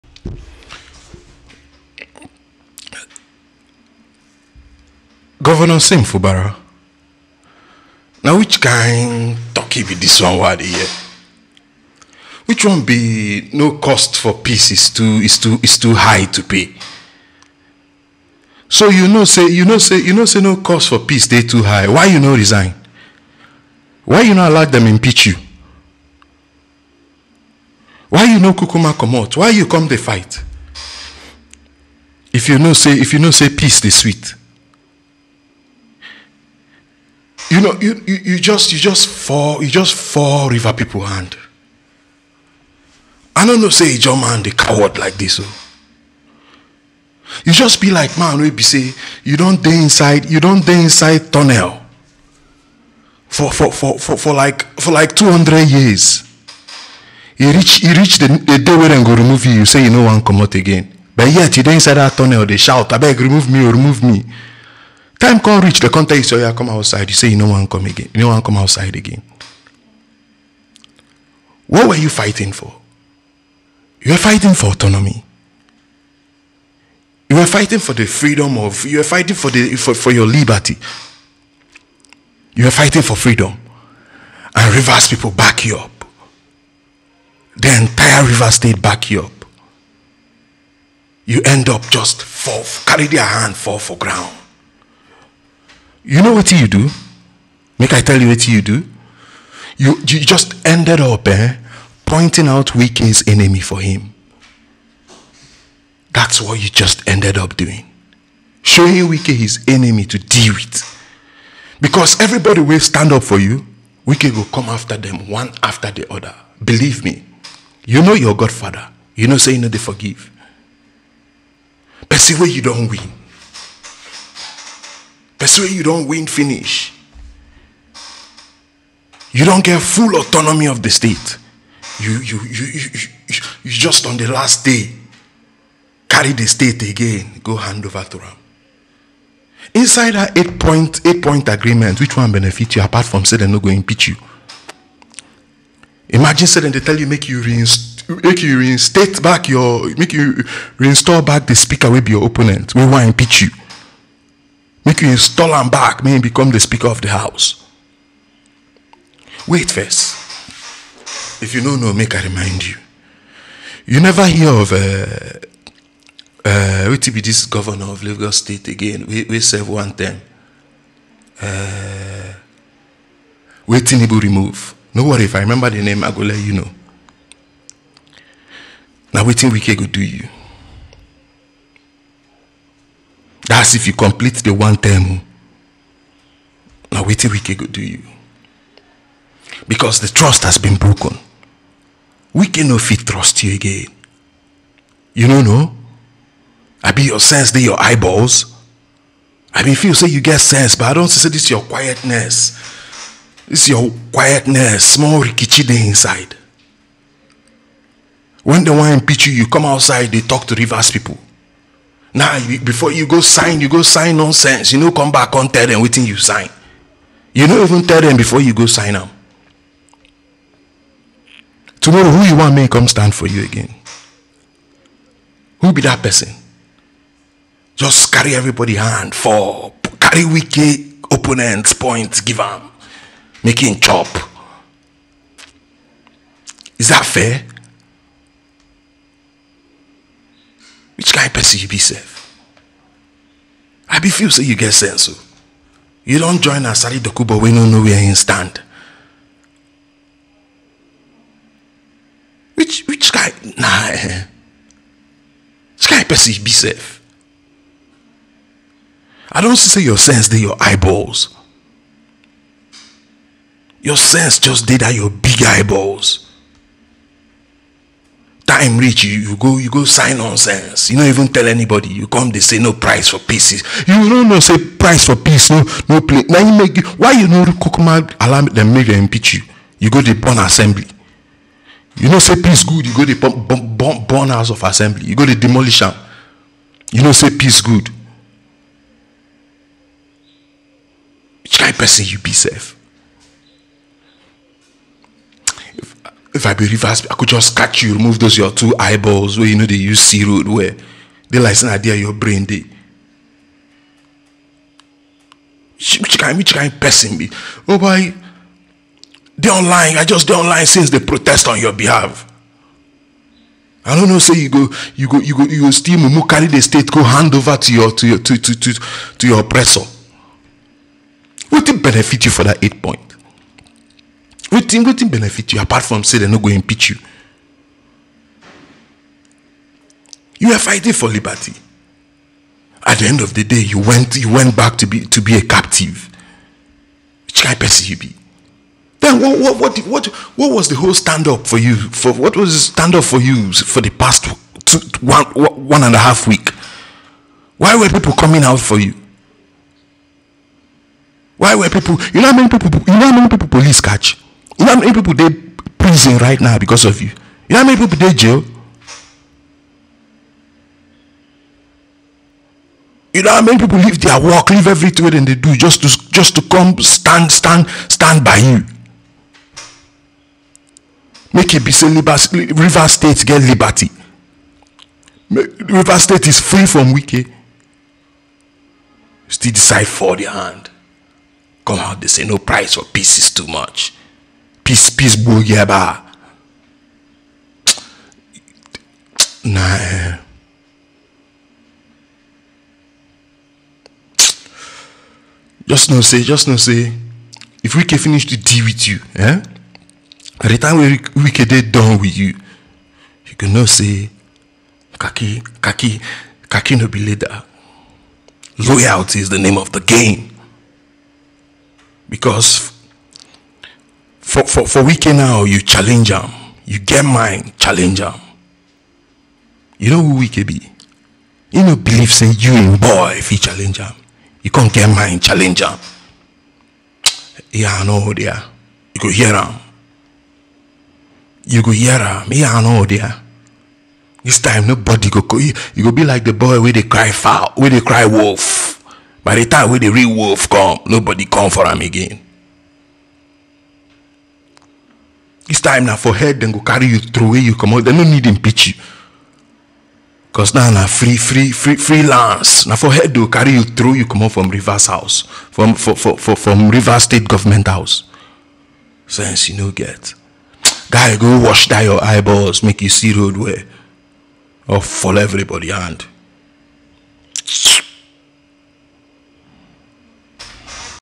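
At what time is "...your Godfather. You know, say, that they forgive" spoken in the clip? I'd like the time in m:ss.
1:58.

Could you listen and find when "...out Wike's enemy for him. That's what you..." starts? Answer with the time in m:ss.
1:42.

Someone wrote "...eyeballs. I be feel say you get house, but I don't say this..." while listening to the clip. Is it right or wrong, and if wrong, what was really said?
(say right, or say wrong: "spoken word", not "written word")
wrong: "sense", not "house".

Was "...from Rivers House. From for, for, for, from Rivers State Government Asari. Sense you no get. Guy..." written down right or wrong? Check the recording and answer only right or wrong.
wrong.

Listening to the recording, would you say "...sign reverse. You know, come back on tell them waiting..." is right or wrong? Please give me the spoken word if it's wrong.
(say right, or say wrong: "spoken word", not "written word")
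wrong: "nonsense", not "reverse".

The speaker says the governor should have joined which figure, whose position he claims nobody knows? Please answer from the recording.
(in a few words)
Asari Dokubo.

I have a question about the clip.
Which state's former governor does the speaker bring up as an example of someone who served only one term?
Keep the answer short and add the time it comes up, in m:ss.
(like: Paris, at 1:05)
Lagos State, at 2:48.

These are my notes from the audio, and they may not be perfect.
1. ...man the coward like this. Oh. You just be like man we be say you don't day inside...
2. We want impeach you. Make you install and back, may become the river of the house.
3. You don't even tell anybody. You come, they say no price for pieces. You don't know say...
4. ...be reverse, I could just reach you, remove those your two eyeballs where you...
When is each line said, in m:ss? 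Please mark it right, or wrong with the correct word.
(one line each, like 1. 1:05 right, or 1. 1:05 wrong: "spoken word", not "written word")
1. 0:44 right
2. 2:32 wrong: "speaker", not "river"
3. 4:30 right
4. 4:56 wrong: "catch", not "reach".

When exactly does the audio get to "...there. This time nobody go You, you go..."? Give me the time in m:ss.
7:12.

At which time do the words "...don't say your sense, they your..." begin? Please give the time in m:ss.
4:19.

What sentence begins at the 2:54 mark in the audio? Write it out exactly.
No worry, if I remember the name, I go let you know.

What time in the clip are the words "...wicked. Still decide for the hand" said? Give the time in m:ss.
6:16.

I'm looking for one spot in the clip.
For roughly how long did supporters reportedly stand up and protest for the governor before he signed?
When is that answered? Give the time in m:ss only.
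5:45.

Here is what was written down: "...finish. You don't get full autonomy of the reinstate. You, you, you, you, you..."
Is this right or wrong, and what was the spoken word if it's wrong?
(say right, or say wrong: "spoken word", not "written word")
wrong: "state", not "reinstate".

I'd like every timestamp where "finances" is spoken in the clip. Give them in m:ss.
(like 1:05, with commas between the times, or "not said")
not said.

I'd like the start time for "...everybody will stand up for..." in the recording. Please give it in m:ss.
1:52.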